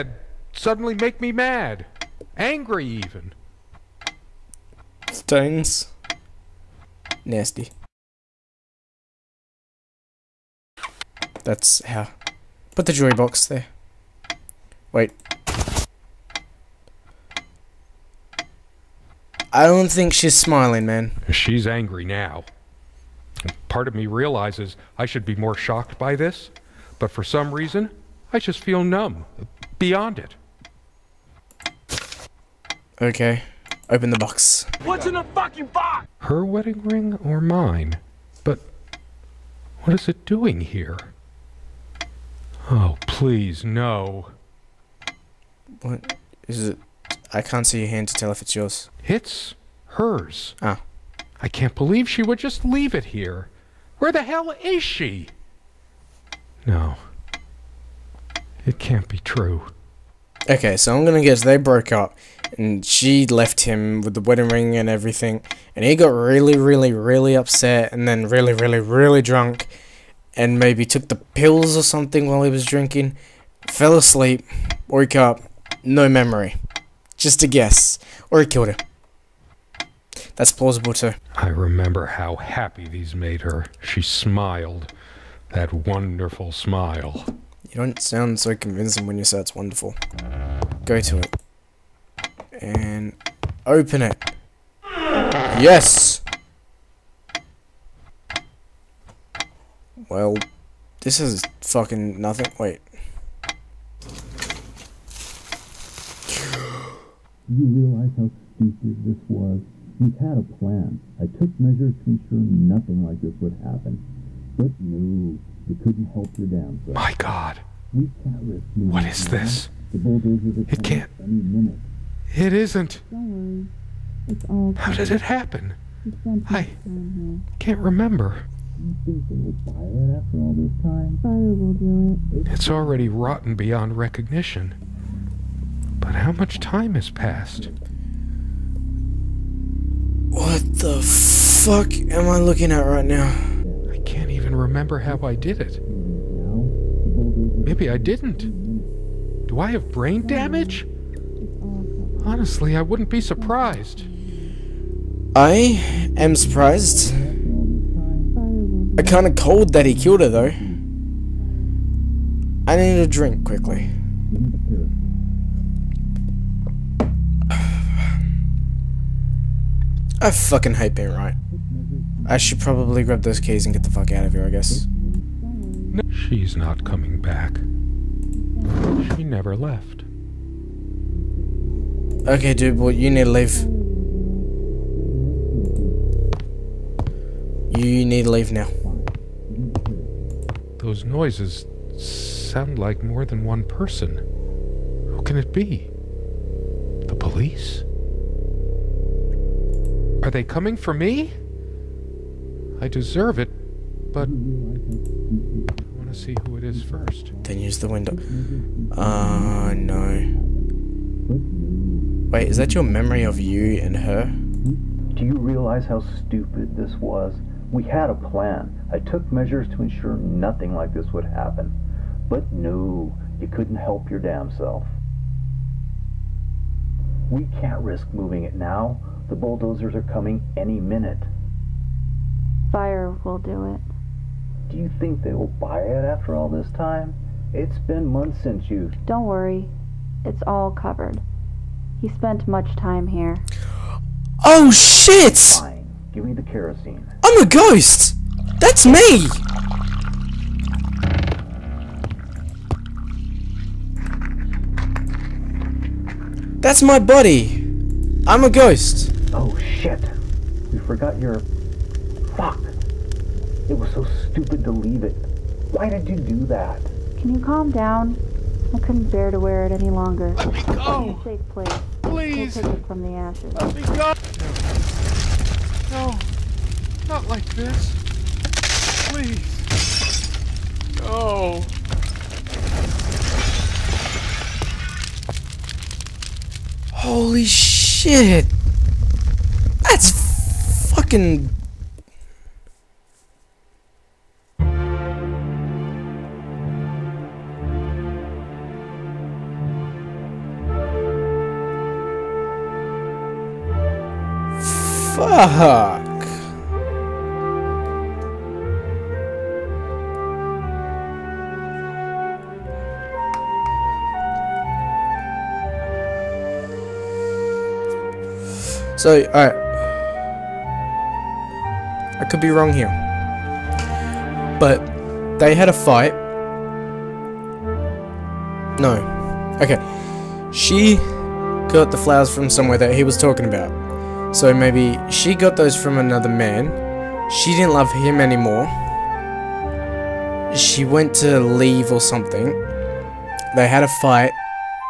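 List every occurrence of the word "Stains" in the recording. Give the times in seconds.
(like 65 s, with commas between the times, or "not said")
5 s.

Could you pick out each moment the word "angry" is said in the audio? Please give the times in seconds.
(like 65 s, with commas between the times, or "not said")
2 s, 21 s.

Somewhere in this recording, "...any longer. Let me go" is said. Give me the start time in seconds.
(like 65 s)
269 s.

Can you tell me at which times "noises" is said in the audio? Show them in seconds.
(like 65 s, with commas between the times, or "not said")
191 s.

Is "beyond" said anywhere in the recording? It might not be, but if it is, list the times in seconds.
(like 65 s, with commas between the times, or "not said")
29 s, 133 s.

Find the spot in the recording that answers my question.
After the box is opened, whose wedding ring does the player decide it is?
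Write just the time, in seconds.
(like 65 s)
49 s.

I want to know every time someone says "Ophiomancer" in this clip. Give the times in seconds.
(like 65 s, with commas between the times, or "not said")
not said.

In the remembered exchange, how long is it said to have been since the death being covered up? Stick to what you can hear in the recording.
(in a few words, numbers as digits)
Months.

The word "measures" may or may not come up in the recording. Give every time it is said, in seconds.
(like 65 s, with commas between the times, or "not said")
111 s, 219 s.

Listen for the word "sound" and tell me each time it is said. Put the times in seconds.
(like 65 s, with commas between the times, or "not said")
87 s, 192 s.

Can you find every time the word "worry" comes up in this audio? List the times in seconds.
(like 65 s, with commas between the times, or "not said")
123 s, 239 s.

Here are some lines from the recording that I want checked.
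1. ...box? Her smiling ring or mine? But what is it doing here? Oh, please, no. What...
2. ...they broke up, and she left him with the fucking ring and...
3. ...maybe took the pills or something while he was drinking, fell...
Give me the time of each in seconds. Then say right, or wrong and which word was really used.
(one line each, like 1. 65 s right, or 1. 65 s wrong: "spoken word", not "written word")
1. 35 s wrong: "wedding", not "smiling"
2. 61 s wrong: "wedding", not "fucking"
3. 70 s right.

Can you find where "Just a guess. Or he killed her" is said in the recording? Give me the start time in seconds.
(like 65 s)
77 s.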